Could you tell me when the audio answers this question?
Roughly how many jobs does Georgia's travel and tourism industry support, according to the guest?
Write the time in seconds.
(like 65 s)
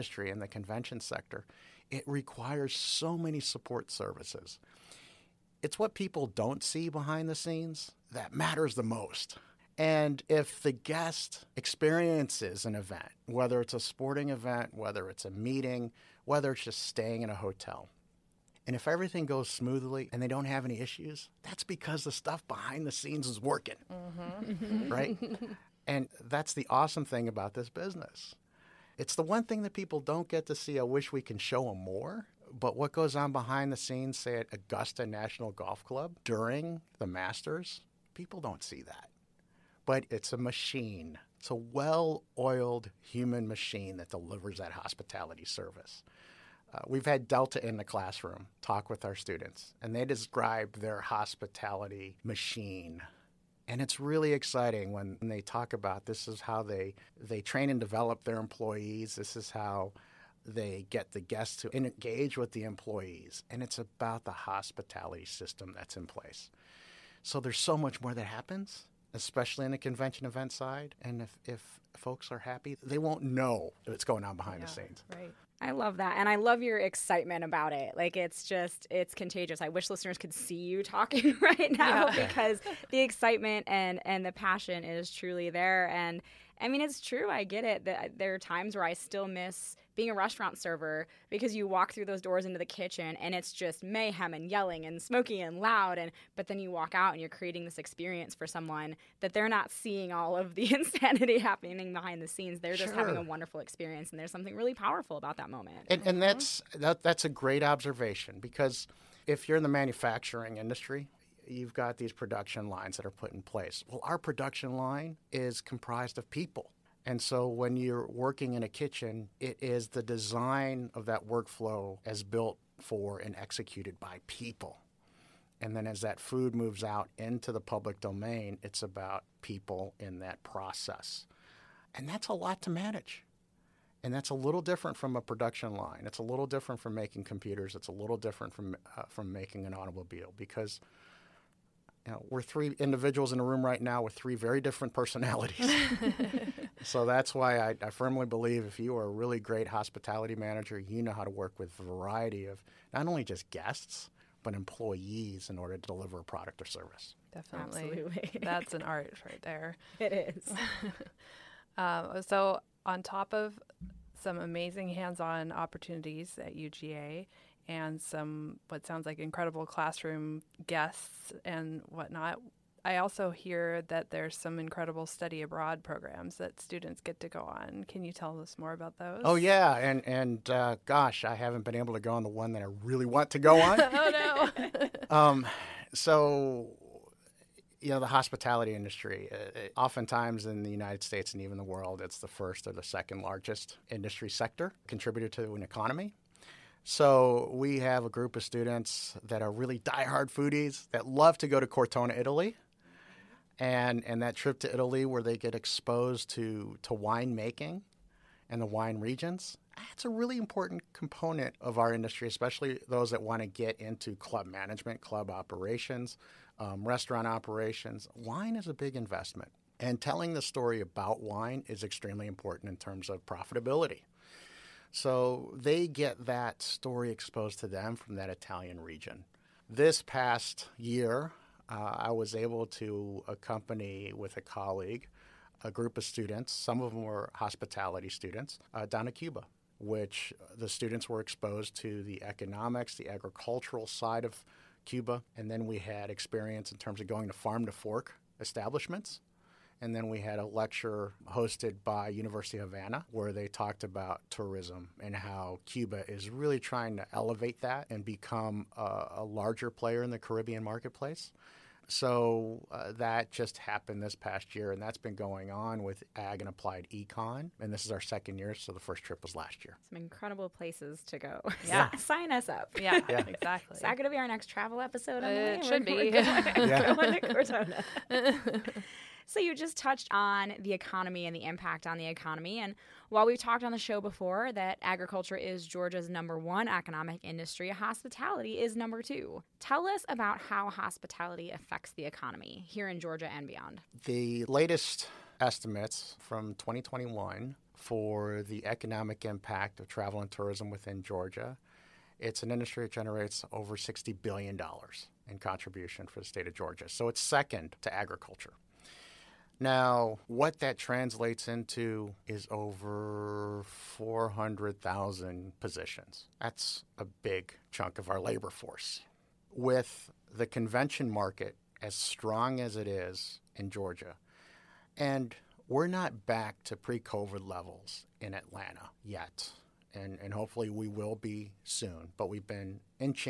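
312 s.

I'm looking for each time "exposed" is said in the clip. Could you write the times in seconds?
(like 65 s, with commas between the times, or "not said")
205 s, 227 s, 241 s.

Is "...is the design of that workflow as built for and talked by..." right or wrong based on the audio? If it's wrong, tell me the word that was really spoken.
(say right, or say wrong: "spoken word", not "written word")
wrong: "executed", not "talked".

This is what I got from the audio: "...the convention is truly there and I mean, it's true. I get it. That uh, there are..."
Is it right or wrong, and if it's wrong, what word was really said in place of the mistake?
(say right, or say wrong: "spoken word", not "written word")
wrong: "passion", not "convention".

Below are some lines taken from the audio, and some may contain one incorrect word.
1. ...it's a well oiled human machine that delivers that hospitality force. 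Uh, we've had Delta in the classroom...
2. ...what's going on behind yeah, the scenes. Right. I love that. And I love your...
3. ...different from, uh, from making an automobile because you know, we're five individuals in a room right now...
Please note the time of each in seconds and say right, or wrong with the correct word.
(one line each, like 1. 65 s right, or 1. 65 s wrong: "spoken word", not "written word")
1. 41 s wrong: "service", not "force"
2. 73 s right
3. 138 s wrong: "three", not "five".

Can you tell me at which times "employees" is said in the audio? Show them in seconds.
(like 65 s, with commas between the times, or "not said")
58 s, 62 s, 154 s.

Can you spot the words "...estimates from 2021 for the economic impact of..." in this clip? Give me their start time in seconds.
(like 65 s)
295 s.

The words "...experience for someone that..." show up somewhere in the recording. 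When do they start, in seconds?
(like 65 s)
97 s.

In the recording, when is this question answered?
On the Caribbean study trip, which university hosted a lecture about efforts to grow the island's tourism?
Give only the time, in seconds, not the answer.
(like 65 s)
252 s.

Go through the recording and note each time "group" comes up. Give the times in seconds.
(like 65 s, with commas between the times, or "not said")
198 s, 235 s.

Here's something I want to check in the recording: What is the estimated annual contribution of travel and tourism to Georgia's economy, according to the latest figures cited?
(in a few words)
over $60 billion.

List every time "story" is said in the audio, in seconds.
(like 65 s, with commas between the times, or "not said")
220 s, 226 s.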